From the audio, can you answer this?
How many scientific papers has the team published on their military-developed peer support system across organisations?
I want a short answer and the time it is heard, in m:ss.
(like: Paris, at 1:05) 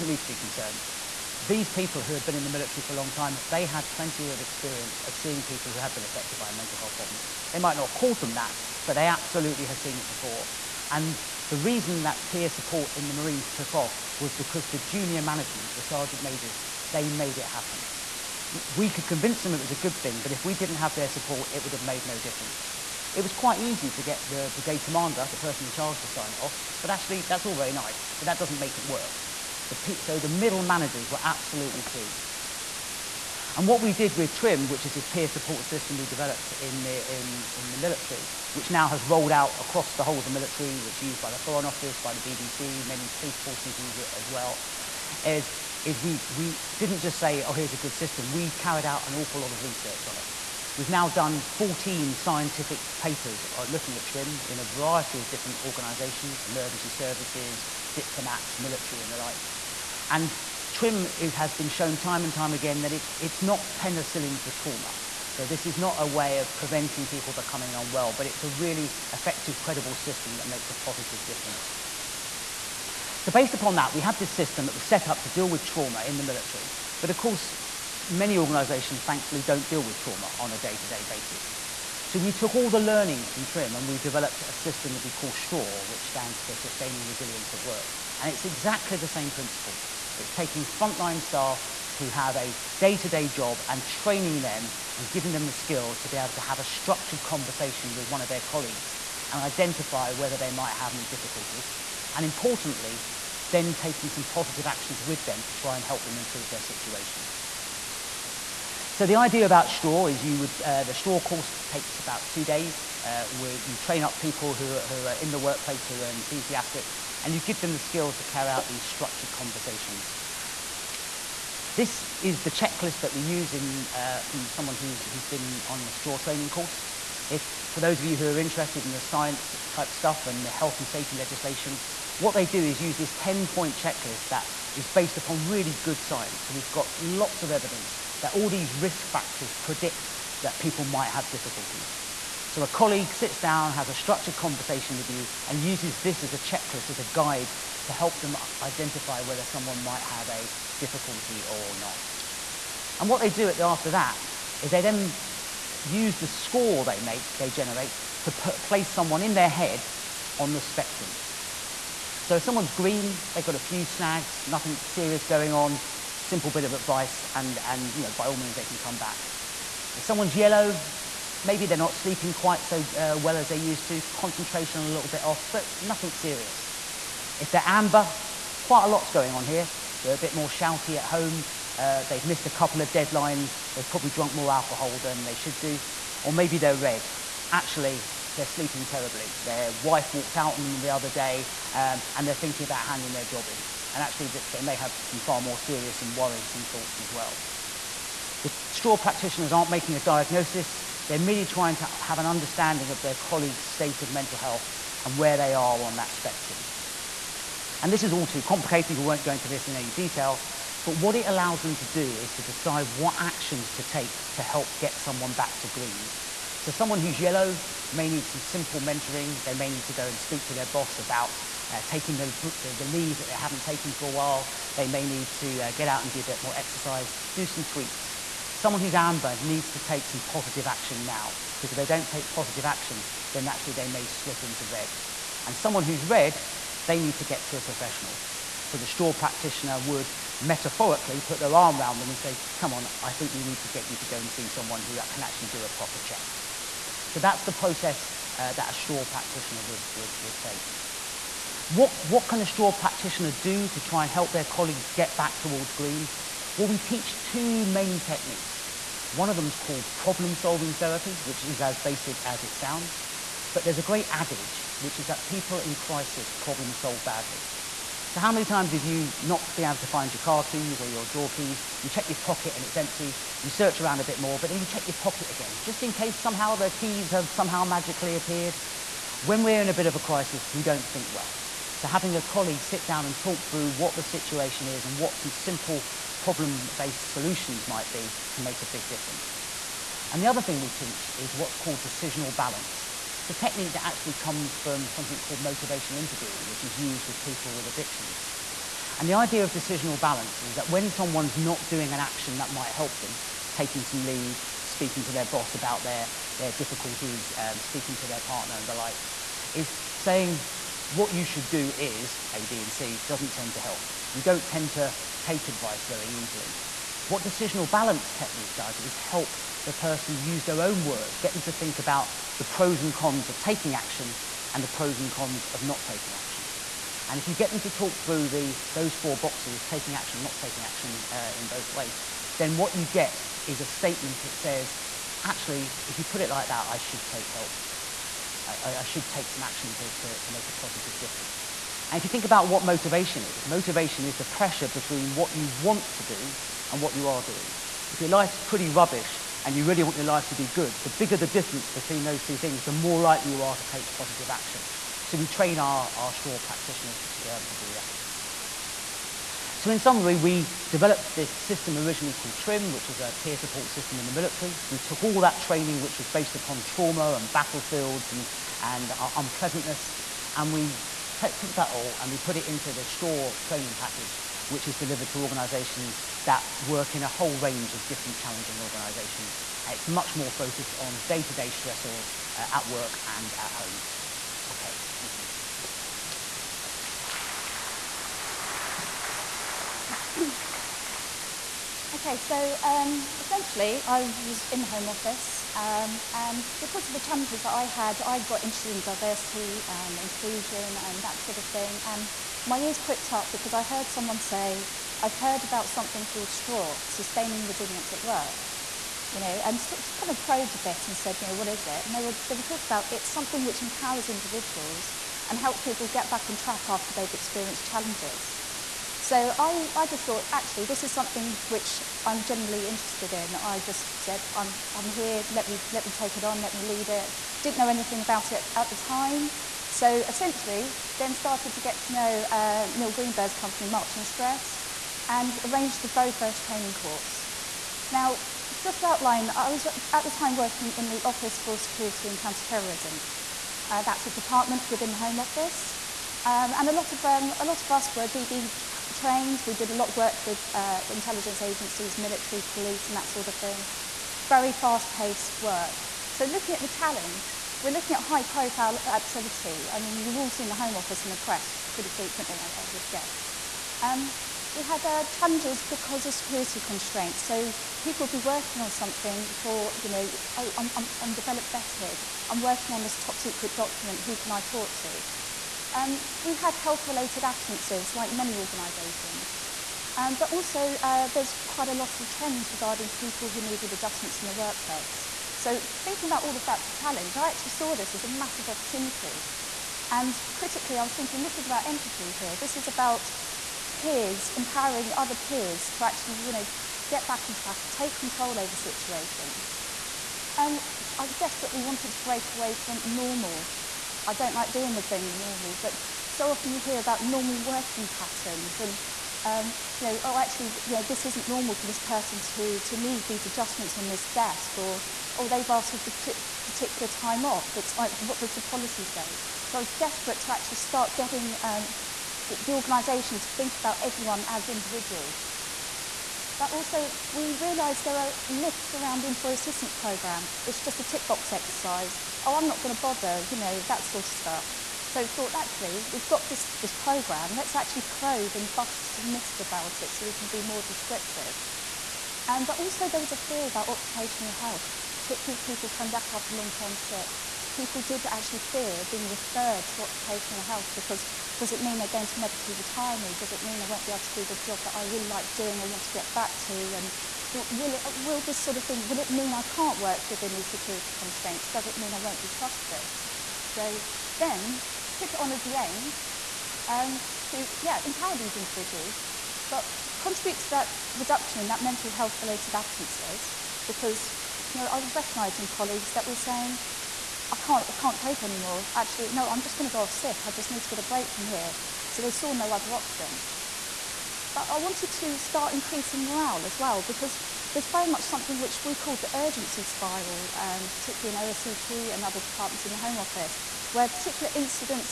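14, at 0:51.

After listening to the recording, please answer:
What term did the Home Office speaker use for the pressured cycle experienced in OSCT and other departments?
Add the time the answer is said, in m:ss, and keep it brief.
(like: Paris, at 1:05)
urgency spiral, at 9:49.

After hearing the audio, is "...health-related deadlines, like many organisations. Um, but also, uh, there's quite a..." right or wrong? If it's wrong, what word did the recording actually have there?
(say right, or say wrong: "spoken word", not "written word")
wrong: "absences", not "deadlines".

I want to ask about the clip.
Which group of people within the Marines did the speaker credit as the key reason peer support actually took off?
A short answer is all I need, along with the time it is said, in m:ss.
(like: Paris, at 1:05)
sergeant majors, at 0:15.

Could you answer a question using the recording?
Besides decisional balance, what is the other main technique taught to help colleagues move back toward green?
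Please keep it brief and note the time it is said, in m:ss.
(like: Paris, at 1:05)
problem-solving therapy, at 4:19.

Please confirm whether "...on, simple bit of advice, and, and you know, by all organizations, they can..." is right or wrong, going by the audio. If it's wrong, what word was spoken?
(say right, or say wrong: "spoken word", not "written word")
wrong: "means", not "organizations".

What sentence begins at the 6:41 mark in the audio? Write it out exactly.
And my ears pricked up because I heard someone say, I've heard about something called STRAW, Sustaining Resilience at Work.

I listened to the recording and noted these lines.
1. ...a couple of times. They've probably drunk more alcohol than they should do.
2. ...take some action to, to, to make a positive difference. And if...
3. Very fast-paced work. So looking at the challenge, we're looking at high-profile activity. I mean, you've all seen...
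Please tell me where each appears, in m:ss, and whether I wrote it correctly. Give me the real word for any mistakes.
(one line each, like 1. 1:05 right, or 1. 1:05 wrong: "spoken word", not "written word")
1. 3:02 wrong: "deadlines", not "times"
2. 5:39 right
3. 7:34 right.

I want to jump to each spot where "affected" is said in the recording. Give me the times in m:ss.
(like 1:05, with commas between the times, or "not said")
0:06.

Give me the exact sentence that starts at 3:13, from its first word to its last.
And actually, they may have some far more serious and worrisome thoughts as well.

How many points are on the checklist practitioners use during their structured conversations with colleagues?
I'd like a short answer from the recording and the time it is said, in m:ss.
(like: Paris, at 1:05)
10, at 2:13.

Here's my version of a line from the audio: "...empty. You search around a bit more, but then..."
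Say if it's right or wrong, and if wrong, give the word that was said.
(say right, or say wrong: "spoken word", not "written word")
right.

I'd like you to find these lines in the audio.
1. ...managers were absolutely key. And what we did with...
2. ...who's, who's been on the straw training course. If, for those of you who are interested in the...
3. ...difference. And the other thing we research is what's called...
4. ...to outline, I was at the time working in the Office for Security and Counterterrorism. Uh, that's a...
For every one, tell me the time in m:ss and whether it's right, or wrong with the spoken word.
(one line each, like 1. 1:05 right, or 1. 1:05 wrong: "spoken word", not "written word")
1. 0:30 right
2. 2:04 right
3. 4:48 wrong: "teach", not "research"
4. 7:18 right.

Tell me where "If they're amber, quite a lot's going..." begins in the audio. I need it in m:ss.
2:57.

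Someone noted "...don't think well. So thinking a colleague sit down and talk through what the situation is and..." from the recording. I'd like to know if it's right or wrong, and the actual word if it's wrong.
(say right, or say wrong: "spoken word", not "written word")
wrong: "having", not "thinking".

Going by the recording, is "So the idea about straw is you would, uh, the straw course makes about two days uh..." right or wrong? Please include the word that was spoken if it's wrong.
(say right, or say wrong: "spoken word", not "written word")
wrong: "takes", not "makes".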